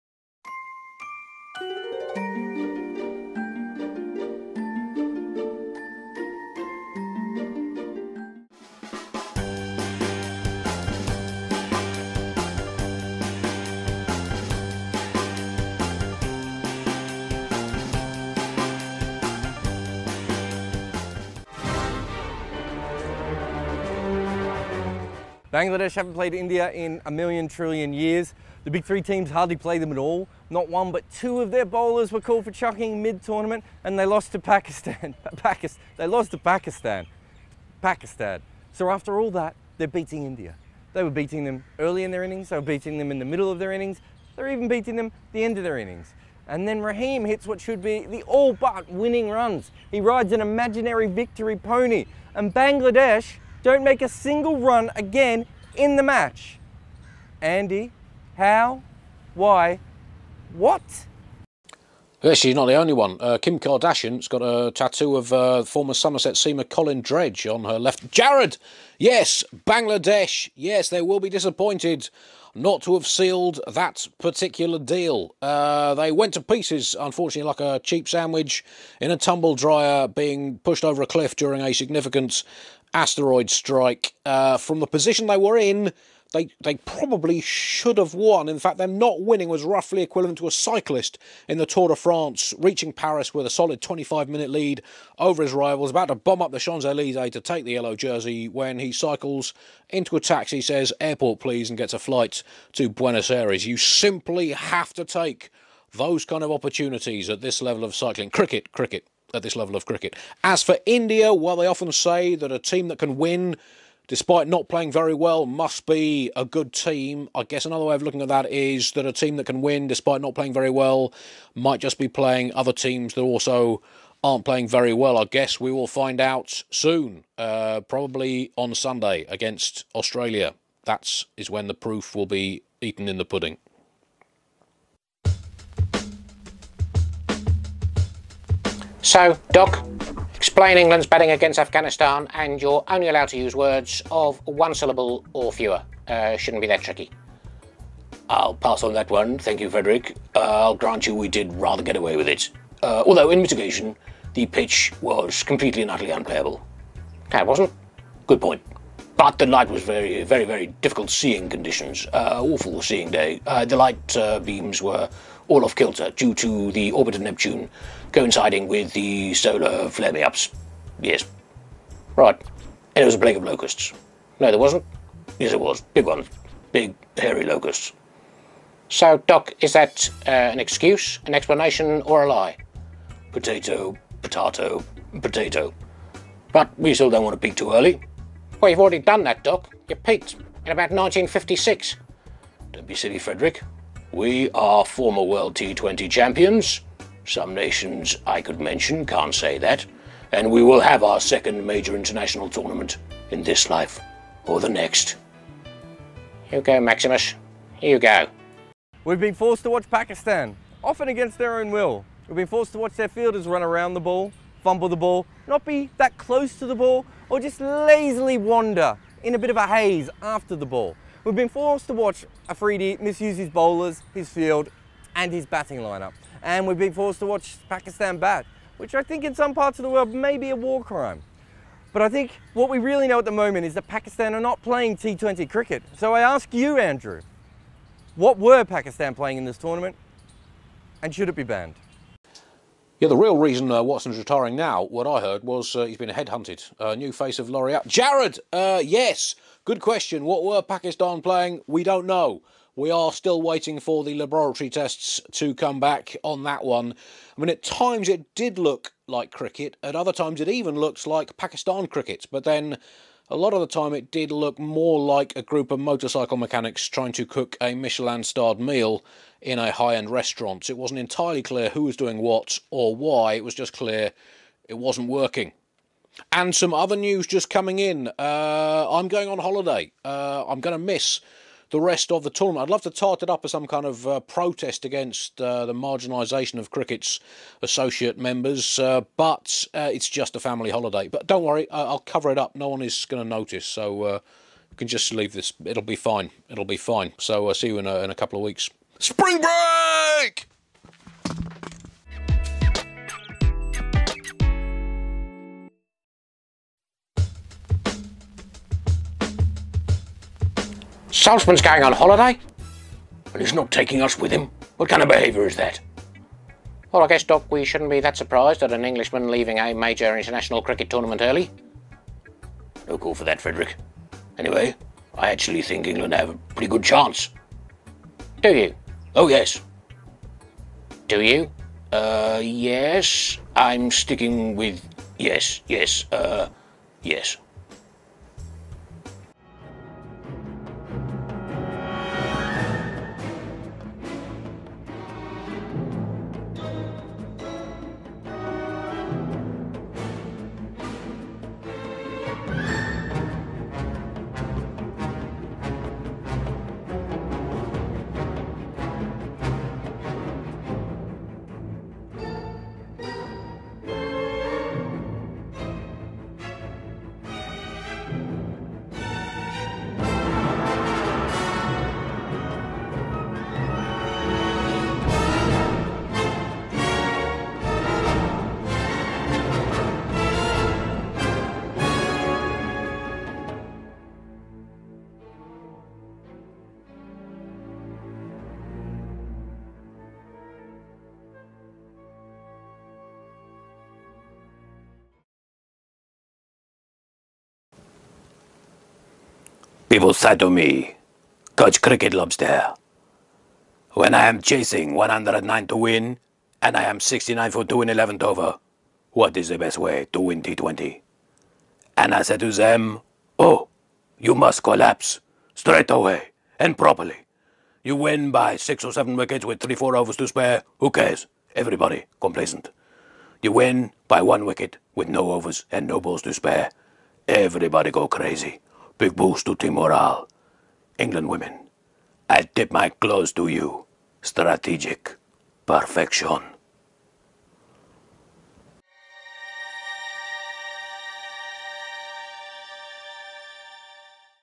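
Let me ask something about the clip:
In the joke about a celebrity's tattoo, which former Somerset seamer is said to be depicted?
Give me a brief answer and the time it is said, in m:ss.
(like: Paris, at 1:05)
Colin Dredge, at 1:06.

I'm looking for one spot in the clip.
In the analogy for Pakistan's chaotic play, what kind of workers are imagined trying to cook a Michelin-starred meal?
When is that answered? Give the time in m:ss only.
4:25.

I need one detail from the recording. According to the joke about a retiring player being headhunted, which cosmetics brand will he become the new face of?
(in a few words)
L'Oreal.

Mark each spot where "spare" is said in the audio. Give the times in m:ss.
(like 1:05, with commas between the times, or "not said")
7:00, 7:06.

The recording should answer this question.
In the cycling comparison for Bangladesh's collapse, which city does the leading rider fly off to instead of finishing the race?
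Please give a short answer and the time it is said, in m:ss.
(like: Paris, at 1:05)
Buenos Aires, at 1:42.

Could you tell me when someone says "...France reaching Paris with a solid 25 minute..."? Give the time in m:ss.
1:31.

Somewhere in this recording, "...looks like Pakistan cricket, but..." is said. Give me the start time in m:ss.
4:20.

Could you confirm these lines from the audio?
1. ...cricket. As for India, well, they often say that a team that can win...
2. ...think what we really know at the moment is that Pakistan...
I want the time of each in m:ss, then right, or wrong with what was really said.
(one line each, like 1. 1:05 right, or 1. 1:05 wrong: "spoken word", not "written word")
1. 1:49 right
2. 3:52 right.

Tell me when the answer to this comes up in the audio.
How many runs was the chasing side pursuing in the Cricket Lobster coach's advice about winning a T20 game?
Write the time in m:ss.
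6:44.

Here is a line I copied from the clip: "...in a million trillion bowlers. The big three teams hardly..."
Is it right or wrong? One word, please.
wrong.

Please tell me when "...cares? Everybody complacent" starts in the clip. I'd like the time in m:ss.
7:00.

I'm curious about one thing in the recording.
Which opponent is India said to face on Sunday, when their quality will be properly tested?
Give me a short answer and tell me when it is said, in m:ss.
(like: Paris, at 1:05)
Australia, at 2:09.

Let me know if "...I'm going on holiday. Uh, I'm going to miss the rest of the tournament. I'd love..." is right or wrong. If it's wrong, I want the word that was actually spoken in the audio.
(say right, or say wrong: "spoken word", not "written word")
right.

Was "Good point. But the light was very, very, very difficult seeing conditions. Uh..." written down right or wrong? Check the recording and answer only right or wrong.
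right.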